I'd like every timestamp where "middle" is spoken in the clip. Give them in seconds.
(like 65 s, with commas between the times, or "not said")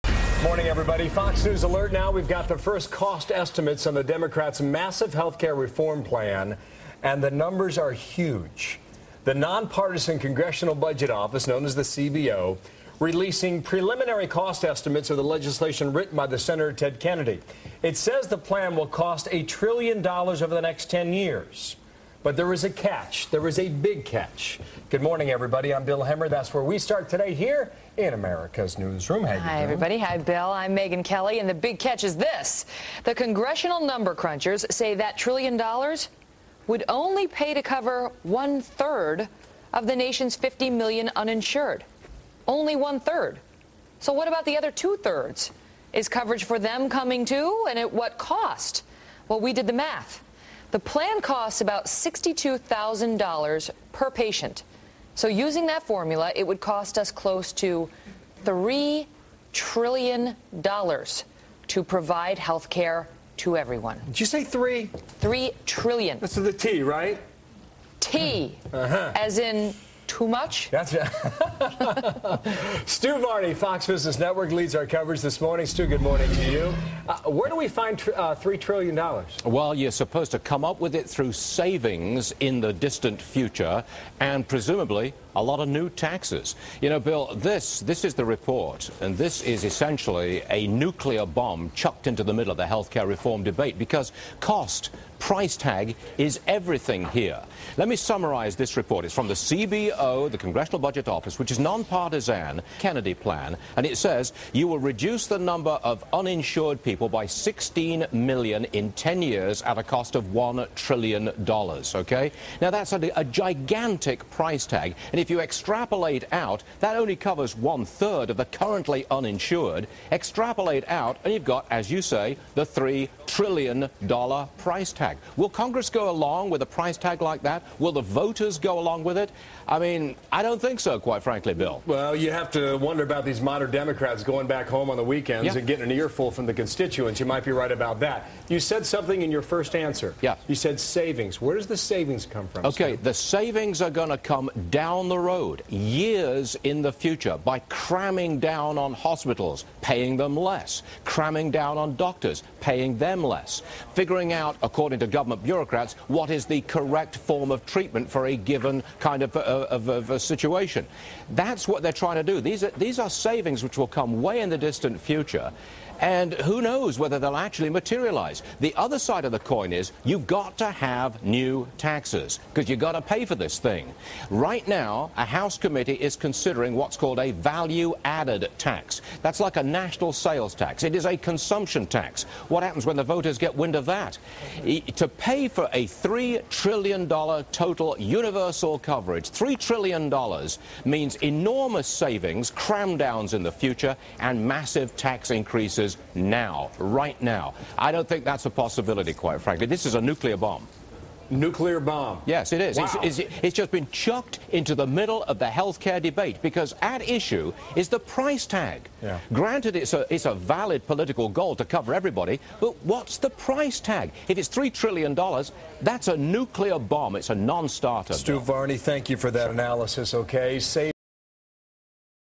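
92 s, 204 s.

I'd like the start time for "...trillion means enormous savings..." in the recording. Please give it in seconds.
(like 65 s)
189 s.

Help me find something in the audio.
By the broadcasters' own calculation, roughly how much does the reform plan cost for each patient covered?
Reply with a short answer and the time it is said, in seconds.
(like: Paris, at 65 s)
$62,000, at 51 s.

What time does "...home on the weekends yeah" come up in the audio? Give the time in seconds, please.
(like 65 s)
134 s.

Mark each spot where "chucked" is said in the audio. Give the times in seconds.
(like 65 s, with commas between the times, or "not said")
91 s, 203 s.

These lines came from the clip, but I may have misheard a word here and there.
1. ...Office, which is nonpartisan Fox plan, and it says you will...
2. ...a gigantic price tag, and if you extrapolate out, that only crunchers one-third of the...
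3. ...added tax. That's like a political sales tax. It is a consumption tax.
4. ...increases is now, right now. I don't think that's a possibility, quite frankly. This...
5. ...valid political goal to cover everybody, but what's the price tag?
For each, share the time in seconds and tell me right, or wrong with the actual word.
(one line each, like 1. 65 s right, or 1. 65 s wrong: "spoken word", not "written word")
1. 101 s wrong: "Kennedy", not "Fox"
2. 113 s wrong: "covers", not "crunchers"
3. 178 s wrong: "national", not "political"
4. 195 s right
5. 210 s right.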